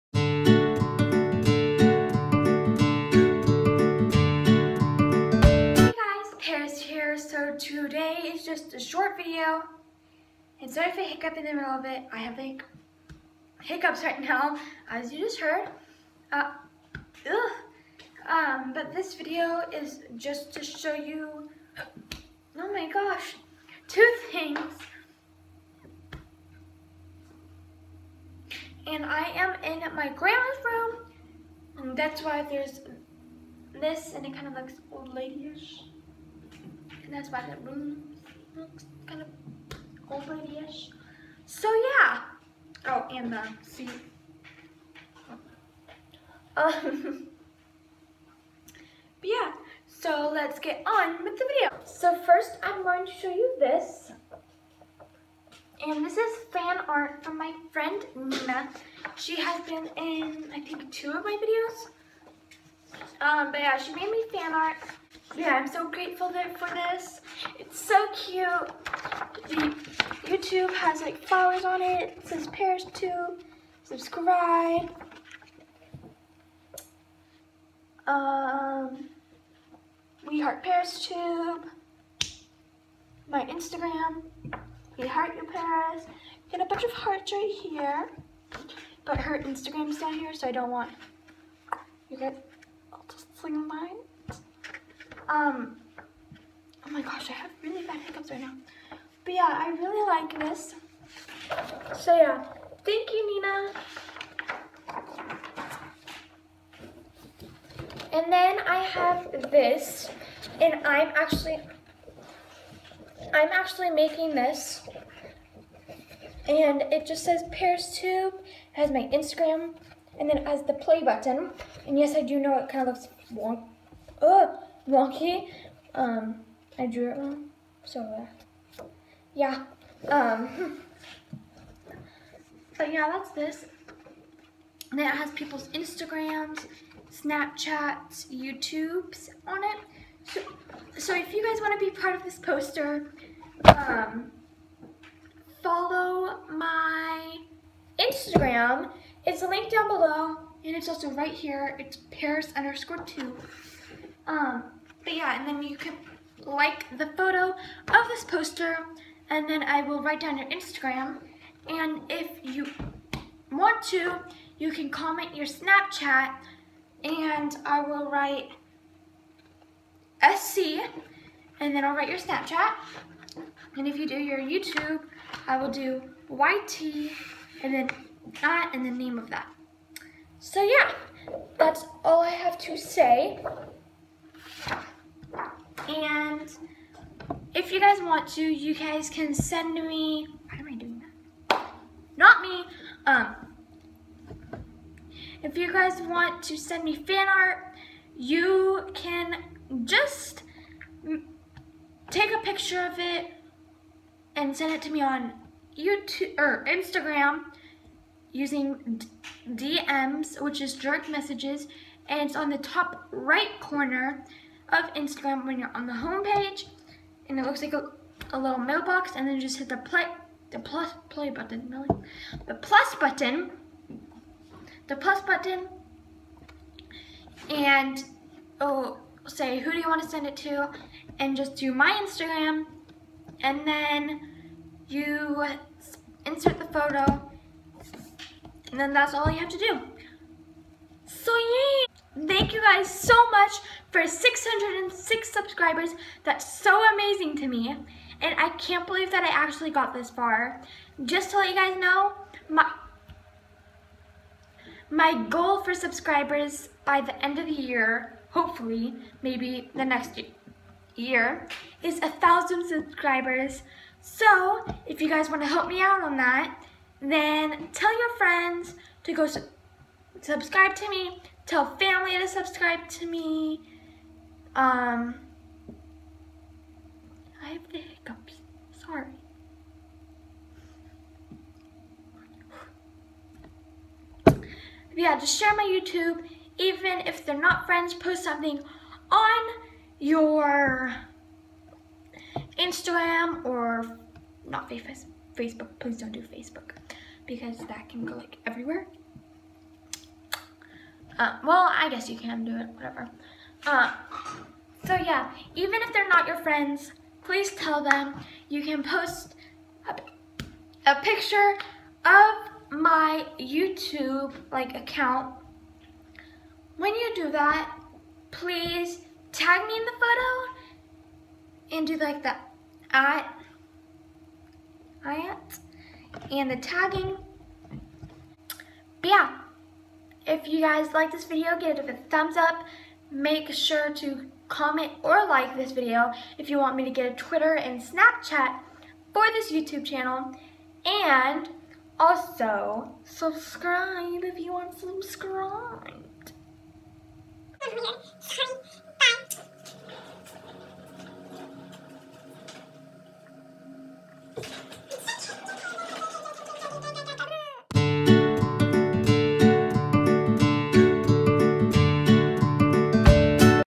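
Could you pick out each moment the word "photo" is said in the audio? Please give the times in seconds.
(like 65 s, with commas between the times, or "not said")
157 s, 236 s, 319 s.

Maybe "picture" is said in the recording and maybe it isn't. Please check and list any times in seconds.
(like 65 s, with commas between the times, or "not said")
202 s, 311 s.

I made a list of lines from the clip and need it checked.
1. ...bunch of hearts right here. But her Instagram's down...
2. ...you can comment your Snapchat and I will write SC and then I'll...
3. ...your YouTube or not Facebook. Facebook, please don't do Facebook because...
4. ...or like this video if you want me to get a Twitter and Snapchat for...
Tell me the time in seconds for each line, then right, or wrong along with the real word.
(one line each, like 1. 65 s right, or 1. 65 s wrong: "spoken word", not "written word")
1. 86 s right
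2. 164 s right
3. 289 s wrong: "Instagram", not "YouTube"
4. 335 s right.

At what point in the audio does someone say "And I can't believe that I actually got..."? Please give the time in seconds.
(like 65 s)
248 s.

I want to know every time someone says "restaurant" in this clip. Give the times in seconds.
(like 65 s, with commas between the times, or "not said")
not said.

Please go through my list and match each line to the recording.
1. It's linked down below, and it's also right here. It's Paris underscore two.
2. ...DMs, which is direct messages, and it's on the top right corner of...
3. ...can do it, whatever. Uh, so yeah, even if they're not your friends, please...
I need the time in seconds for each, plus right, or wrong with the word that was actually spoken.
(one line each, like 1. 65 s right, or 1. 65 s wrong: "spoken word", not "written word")
1. 149 s right
2. 209 s right
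3. 302 s right.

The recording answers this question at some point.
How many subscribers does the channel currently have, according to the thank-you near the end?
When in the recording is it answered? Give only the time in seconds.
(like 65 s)
244 s.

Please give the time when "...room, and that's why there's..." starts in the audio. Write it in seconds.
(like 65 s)
30 s.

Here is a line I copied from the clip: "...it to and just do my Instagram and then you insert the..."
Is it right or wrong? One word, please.
right.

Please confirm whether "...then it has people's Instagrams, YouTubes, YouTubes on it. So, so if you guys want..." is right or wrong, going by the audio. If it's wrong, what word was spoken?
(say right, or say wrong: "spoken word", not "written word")
wrong: "Snapchats", not "YouTubes".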